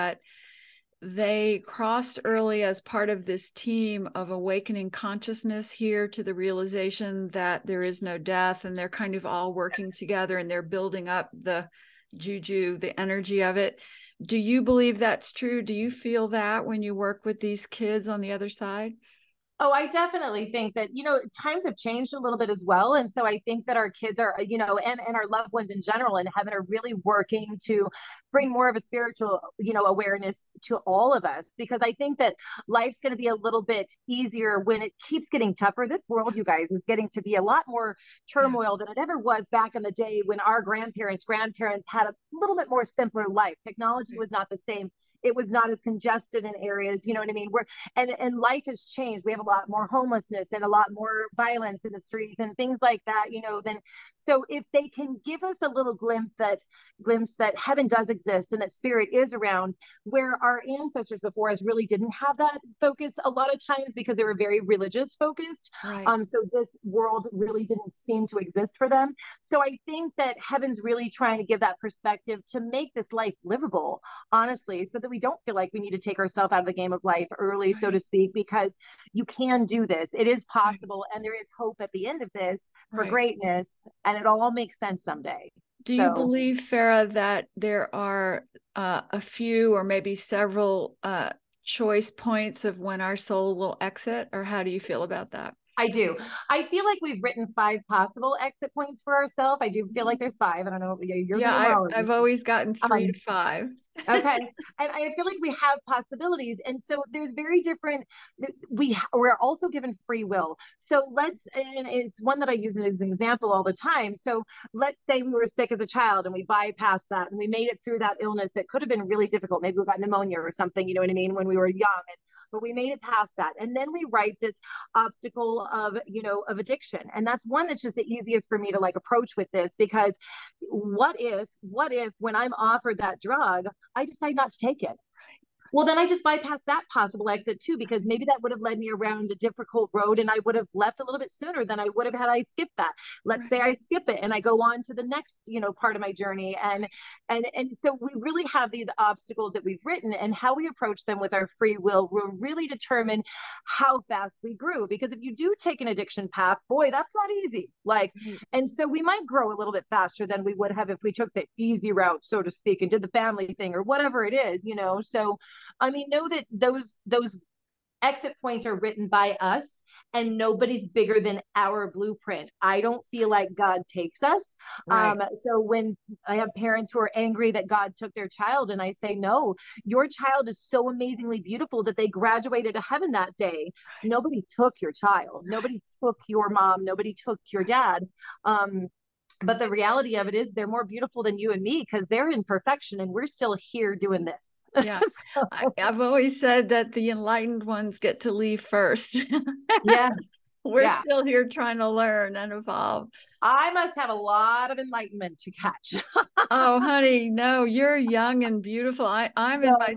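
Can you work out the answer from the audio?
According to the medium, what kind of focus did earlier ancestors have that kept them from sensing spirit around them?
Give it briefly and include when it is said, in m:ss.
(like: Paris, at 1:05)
religious, at 1:04.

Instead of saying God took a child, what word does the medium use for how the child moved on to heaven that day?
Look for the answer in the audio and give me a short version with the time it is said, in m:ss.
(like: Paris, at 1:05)
graduated, at 3:02.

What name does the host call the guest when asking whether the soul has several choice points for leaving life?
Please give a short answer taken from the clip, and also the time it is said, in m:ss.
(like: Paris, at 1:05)
Fara, at 1:26.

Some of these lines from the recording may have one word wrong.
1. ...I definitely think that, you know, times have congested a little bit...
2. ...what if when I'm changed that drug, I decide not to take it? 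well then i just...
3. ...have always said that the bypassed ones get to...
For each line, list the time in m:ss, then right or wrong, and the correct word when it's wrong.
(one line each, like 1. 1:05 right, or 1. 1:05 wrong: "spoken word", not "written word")
1. 0:19 wrong: "changed", not "congested"
2. 2:11 wrong: "offered", not "changed"
3. 3:15 wrong: "enlightened", not "bypassed".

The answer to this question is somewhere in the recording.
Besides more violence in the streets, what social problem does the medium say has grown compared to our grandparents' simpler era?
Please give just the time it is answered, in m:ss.
0:49.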